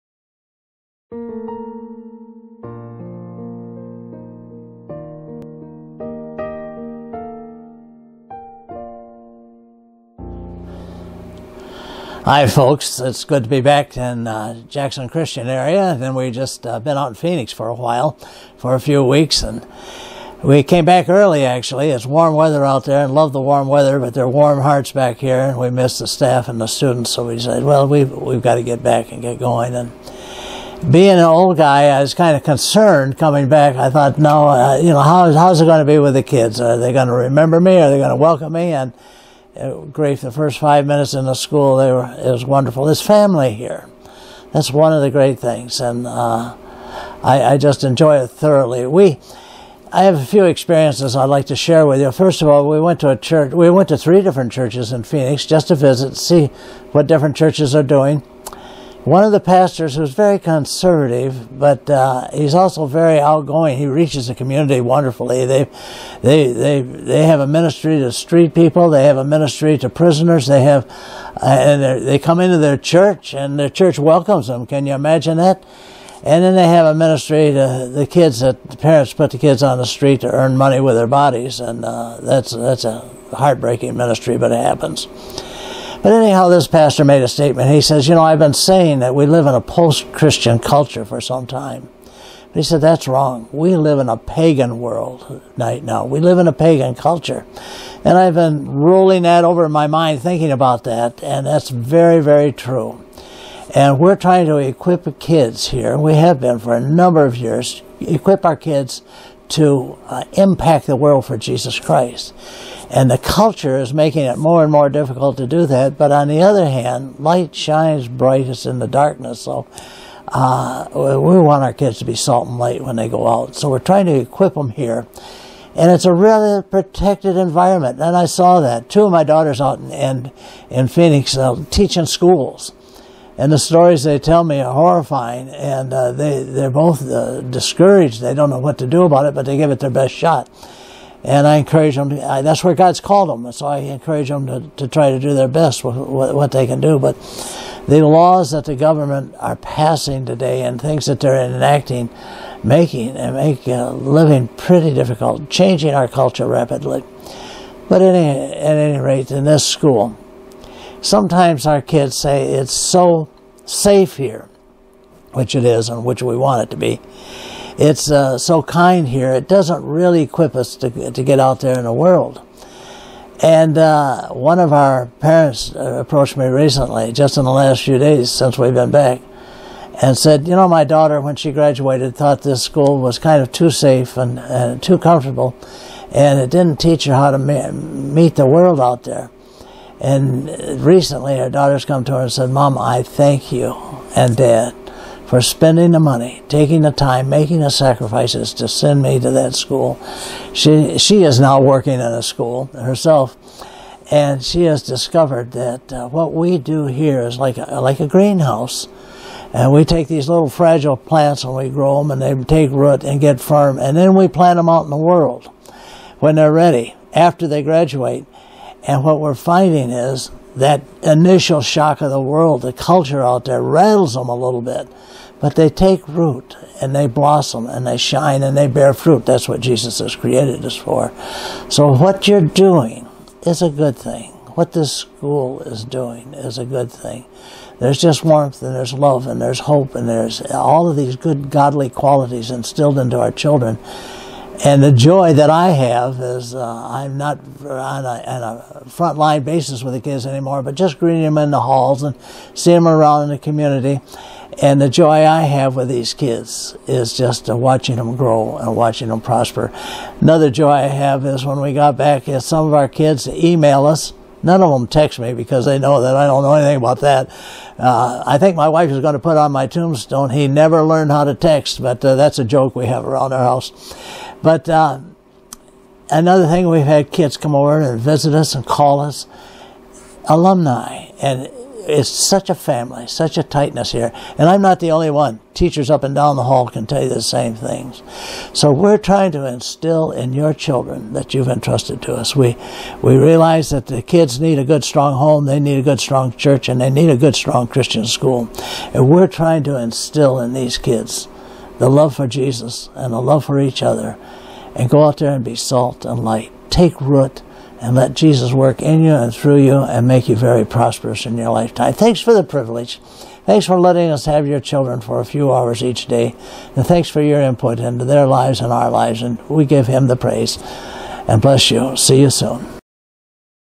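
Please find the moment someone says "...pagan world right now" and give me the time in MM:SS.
01:34.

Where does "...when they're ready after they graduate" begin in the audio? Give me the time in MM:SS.
03:36.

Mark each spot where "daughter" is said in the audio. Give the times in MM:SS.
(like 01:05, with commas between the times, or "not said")
02:09, 03:00, 03:11.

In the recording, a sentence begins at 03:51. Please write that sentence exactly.
So what you're doing is a good thing.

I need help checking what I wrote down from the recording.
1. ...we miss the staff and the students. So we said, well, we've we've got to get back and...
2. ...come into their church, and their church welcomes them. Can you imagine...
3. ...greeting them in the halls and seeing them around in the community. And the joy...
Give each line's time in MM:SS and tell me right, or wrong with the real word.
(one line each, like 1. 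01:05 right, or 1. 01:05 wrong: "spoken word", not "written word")
1. 00:25 right
2. 01:12 right
3. 04:10 right.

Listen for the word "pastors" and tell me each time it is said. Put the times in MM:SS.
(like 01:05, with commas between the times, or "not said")
00:59, 01:26.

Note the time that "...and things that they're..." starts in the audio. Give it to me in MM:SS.
02:30.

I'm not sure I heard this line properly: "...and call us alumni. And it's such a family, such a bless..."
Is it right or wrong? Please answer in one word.
wrong.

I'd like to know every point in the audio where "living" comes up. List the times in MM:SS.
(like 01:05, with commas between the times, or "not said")
02:33.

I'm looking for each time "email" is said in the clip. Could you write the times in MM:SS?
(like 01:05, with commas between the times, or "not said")
04:23.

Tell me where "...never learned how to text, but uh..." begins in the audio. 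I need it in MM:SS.
04:30.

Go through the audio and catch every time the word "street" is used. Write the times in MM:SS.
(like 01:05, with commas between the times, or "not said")
01:08, 01:19.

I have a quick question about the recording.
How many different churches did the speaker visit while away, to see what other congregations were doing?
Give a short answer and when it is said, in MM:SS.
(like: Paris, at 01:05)
3, at 00:53.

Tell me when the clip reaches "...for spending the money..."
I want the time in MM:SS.
03:15.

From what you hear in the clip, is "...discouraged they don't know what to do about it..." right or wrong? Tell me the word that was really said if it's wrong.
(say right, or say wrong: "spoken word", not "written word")
right.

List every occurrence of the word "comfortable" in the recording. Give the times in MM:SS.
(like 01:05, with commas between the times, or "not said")
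03:04.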